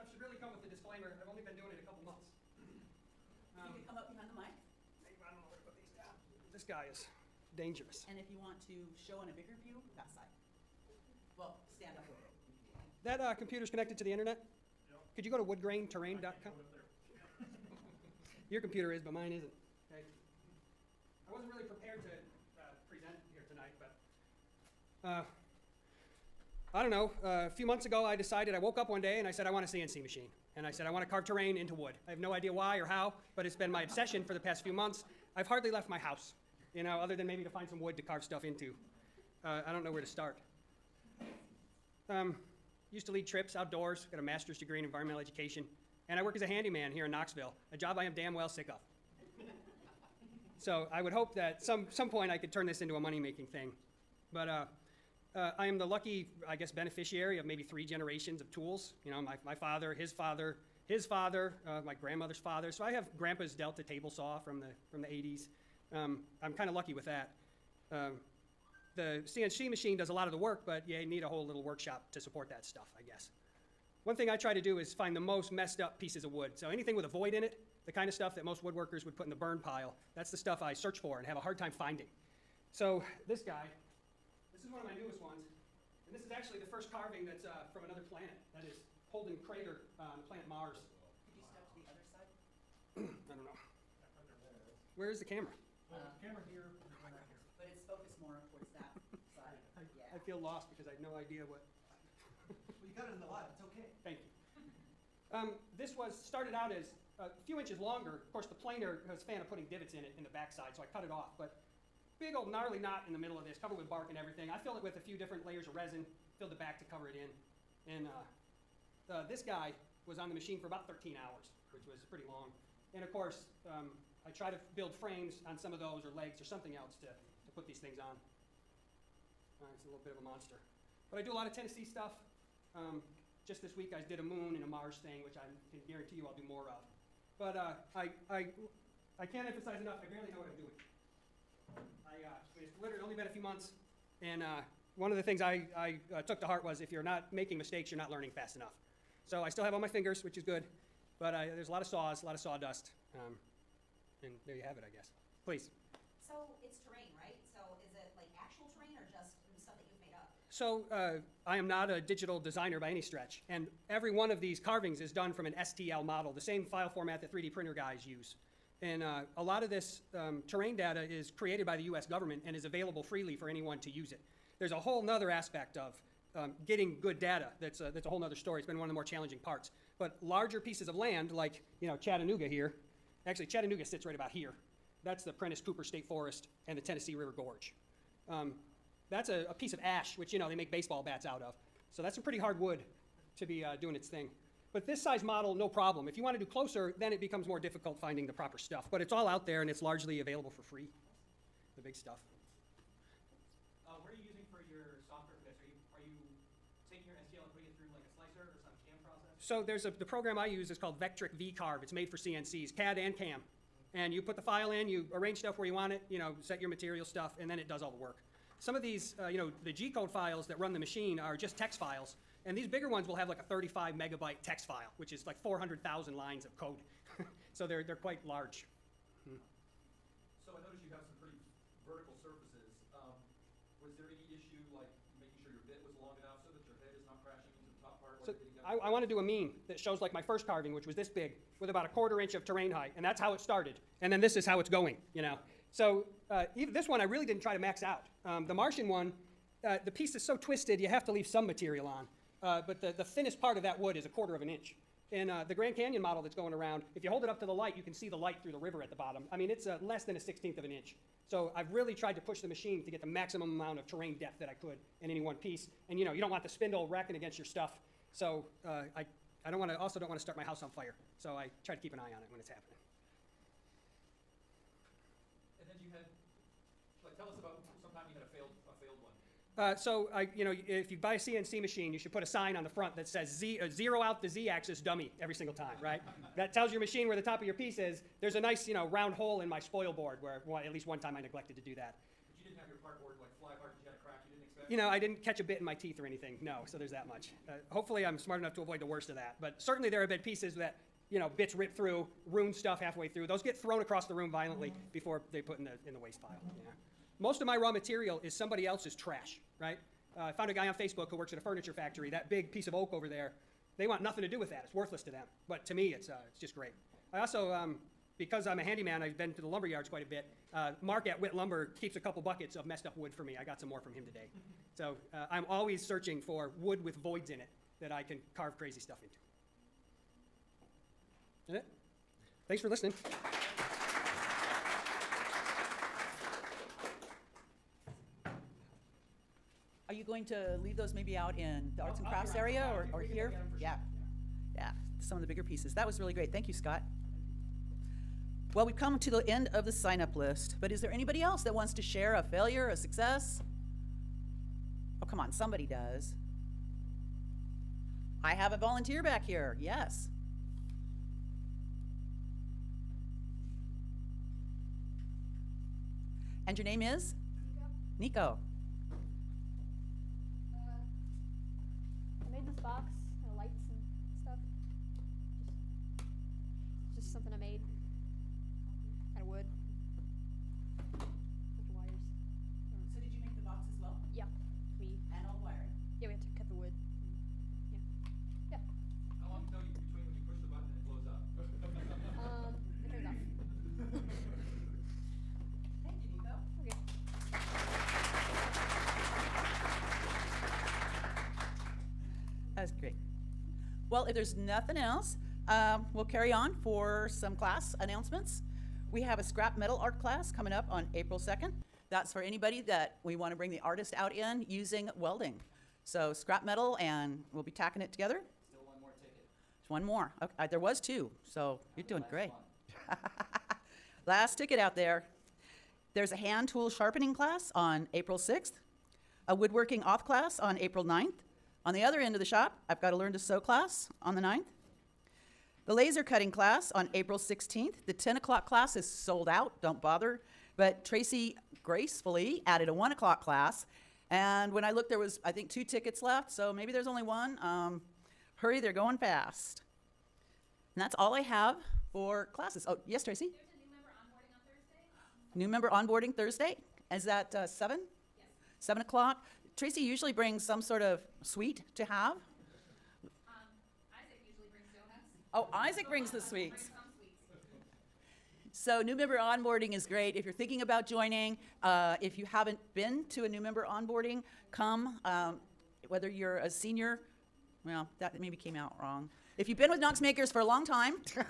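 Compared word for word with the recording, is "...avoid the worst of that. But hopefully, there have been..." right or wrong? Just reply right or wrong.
wrong.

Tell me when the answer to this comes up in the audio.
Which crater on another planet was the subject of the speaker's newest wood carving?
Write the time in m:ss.
1:29.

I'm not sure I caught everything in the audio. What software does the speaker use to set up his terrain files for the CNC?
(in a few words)
Vectric VCarve.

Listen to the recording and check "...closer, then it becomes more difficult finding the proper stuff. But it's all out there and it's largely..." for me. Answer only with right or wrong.
right.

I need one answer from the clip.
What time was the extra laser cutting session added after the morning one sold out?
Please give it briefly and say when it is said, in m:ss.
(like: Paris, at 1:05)
1 o'clock, at 7:22.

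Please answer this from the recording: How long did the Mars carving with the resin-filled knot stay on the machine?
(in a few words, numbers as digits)
13 hours.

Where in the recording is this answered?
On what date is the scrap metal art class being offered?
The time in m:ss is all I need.
6:50.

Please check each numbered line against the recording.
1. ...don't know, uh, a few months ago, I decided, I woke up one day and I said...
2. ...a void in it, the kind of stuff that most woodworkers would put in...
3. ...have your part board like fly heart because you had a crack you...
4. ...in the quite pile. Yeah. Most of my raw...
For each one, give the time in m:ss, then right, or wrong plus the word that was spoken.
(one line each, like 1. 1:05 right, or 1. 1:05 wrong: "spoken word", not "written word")
1. 0:26 right
2. 1:17 right
3. 4:52 wrong: "apart", not "heart"
4. 5:05 wrong: "waste", not "quite".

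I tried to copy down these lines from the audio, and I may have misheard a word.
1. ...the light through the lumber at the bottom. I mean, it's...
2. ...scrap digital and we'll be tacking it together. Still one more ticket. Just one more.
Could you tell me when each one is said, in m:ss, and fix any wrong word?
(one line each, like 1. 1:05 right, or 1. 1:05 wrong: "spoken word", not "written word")
1. 4:18 wrong: "river", not "lumber"
2. 6:56 wrong: "metal", not "digital".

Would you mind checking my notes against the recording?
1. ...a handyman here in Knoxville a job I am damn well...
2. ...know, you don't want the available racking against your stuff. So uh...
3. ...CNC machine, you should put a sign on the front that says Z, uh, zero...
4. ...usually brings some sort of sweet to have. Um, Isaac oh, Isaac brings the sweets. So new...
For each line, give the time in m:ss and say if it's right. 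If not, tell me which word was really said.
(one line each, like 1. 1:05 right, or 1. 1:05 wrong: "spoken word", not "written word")
1. 0:46 right
2. 4:26 wrong: "spindle", not "available"
3. 4:41 right
4. 7:39 right.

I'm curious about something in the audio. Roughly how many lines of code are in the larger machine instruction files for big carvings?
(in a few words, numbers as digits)
400,000.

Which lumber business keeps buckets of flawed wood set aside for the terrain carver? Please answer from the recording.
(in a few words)
Whit Lumber.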